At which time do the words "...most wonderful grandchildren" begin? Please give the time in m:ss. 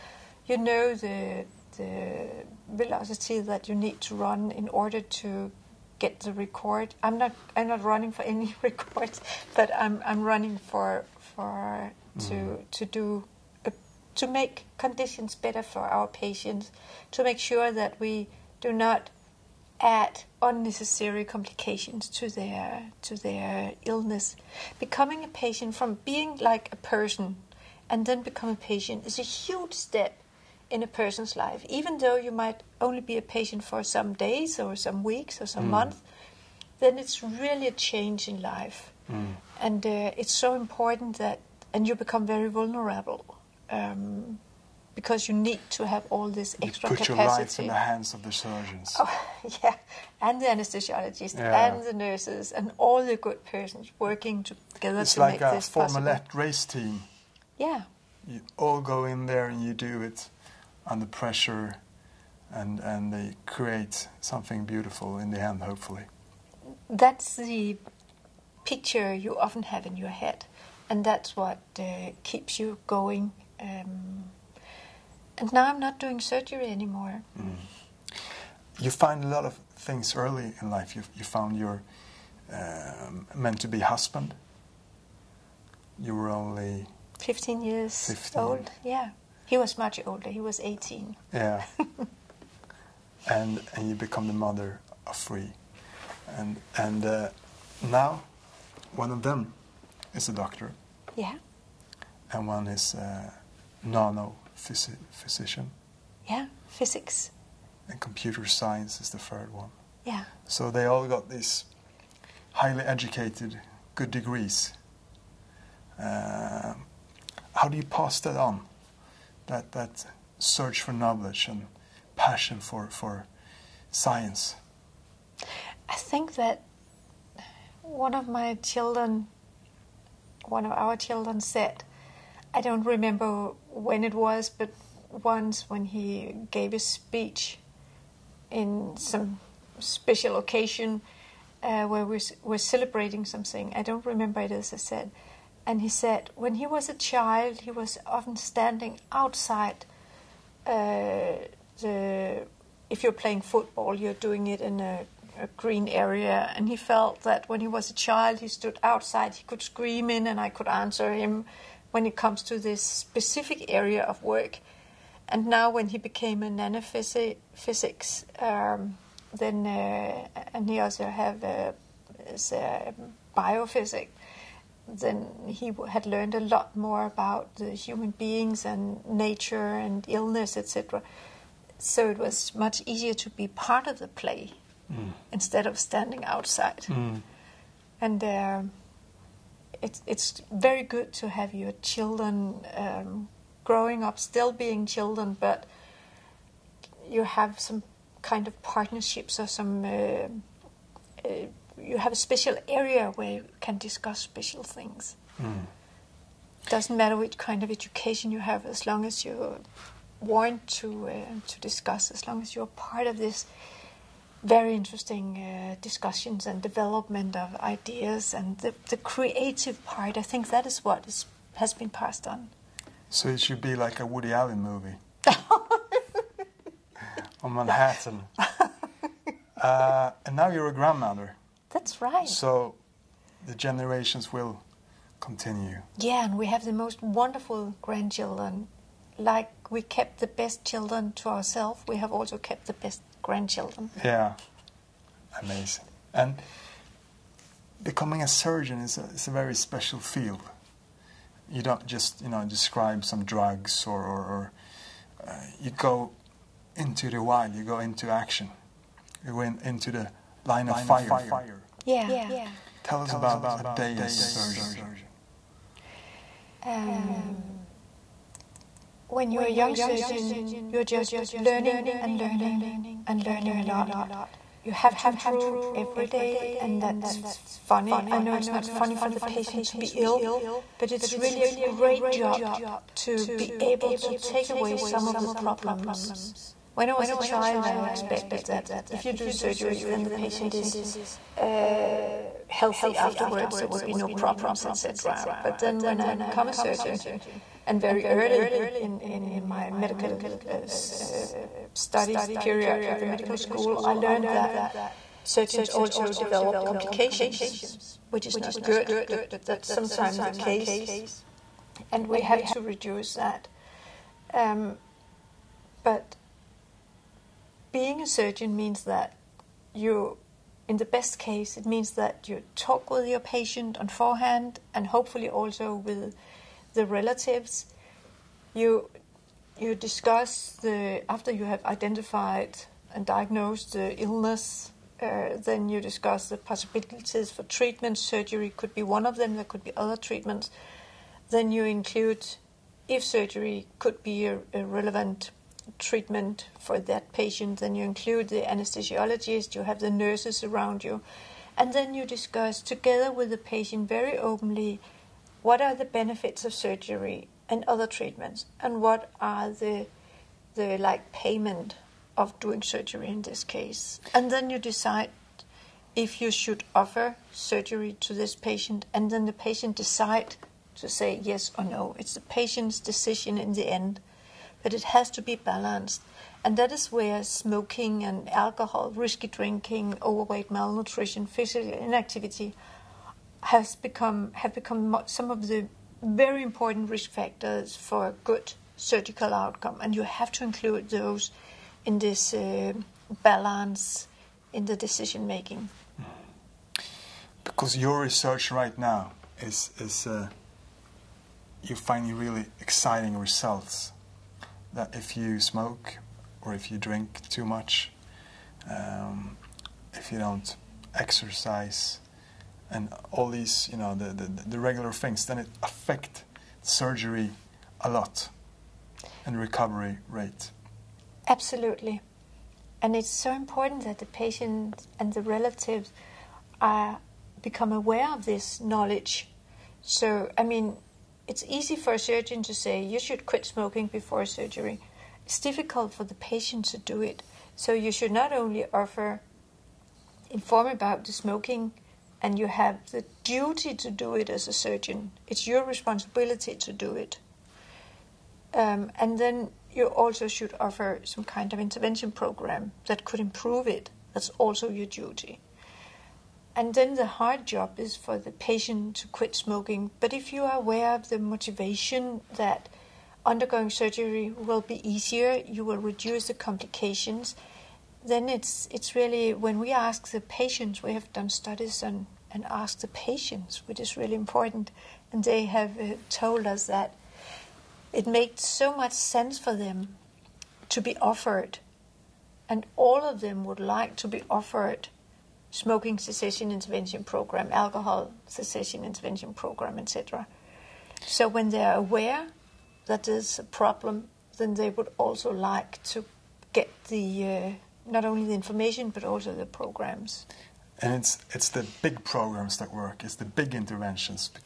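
3:56.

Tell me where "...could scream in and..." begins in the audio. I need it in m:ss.
2:39.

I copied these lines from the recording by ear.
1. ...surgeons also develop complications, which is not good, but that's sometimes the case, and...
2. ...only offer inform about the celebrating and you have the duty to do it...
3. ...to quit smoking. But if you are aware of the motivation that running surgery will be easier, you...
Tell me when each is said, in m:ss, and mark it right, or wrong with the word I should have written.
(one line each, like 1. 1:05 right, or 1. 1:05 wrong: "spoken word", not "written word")
1. 5:05 right
2. 7:18 wrong: "smoking", not "celebrating"
3. 7:38 wrong: "undergoing", not "running".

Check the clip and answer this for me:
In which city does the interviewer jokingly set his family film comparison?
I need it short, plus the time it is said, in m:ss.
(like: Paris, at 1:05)
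Manhattan, at 3:47.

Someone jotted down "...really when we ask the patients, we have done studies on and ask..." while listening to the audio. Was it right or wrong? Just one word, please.
right.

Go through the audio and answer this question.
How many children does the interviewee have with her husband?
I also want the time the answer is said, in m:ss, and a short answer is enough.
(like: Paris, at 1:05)
3, at 1:35.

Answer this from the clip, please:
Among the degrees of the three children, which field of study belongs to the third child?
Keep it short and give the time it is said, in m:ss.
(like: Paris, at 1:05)
Computer science, at 1:47.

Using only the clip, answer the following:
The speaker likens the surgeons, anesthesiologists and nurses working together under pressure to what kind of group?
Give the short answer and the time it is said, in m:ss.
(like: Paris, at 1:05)
A race team, at 0:56.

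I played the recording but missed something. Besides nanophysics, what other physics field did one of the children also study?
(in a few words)
Biophysics.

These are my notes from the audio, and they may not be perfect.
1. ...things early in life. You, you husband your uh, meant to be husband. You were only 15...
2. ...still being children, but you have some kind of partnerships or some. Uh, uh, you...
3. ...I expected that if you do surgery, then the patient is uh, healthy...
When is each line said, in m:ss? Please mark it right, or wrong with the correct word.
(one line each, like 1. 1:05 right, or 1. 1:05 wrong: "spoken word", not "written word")
1. 1:19 wrong: "found", not "husband"
2. 3:14 right
3. 4:47 right.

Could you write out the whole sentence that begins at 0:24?
Becoming a patient from being like a person and then become a patient is a huge step in a person's life.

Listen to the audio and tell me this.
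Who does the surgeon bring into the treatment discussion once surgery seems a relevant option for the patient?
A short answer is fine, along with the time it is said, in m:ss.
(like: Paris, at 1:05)
The anesthesiologist, at 5:48.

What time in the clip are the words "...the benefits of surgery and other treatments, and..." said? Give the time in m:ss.
5:55.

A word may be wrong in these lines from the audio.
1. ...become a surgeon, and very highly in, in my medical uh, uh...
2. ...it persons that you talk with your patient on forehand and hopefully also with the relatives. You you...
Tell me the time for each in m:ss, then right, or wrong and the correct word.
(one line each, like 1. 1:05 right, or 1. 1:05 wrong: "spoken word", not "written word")
1. 4:56 wrong: "early", not "highly"
2. 5:21 wrong: "means", not "persons".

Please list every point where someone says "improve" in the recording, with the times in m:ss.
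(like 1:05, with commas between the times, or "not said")
4:35, 7:33.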